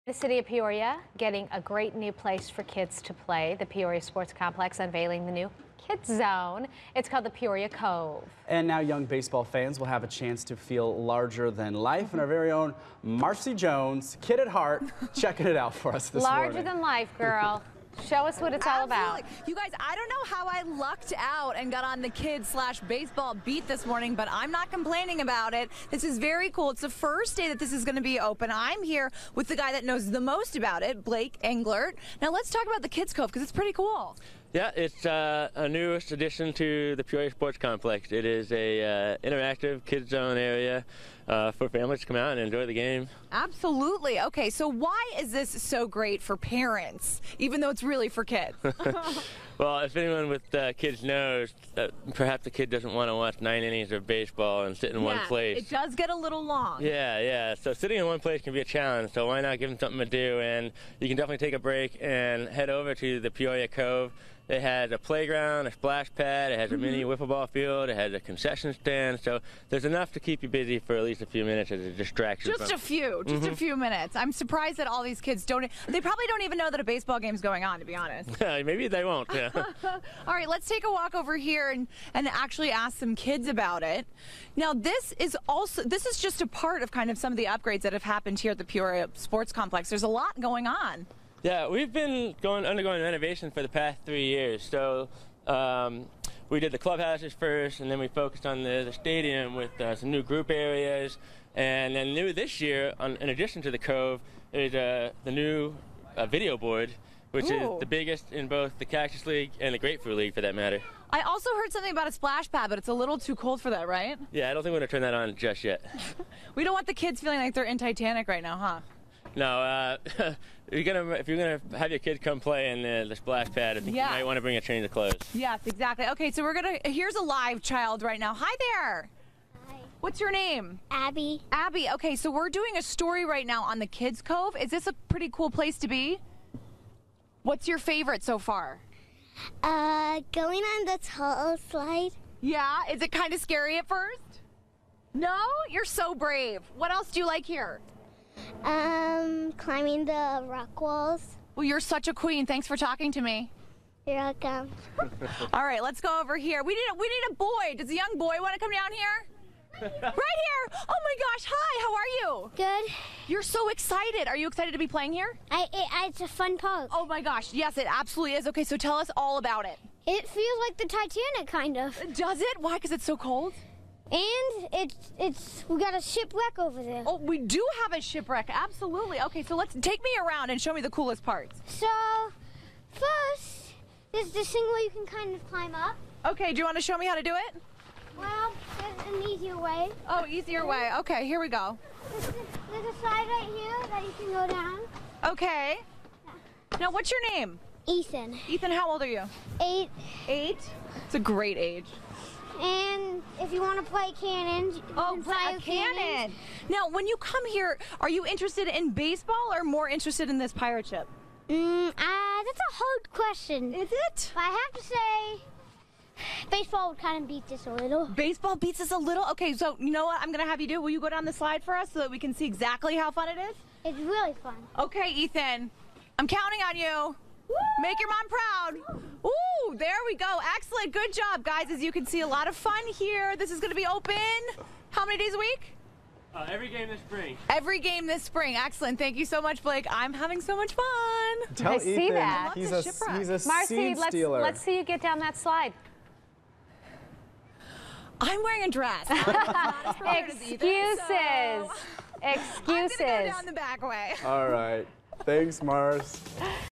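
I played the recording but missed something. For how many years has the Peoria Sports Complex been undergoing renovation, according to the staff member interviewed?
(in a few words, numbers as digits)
3.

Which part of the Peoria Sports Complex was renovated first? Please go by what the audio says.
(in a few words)
The clubhouses.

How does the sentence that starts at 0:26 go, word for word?
It's the first day that this is going to be open.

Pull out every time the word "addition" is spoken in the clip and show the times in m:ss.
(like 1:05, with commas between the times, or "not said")
0:36, 1:43.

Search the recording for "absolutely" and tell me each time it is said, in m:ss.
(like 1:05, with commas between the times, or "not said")
0:18, 0:43, 2:47, 2:58.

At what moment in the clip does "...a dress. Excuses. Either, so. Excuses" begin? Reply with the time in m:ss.
4:08.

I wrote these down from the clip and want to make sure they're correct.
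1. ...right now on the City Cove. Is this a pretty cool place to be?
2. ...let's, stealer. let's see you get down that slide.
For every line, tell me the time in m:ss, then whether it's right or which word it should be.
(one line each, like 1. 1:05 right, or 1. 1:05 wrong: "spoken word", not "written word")
1. 2:13 wrong: "Kids", not "City"
2. 4:03 right.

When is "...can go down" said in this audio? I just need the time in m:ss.
3:14.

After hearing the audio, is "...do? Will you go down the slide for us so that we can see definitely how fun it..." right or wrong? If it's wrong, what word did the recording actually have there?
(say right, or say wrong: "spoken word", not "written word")
wrong: "exactly", not "definitely".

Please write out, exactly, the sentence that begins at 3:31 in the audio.
Mm, uh, that's a hard question.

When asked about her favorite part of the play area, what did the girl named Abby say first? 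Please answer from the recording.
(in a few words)
The tall slide.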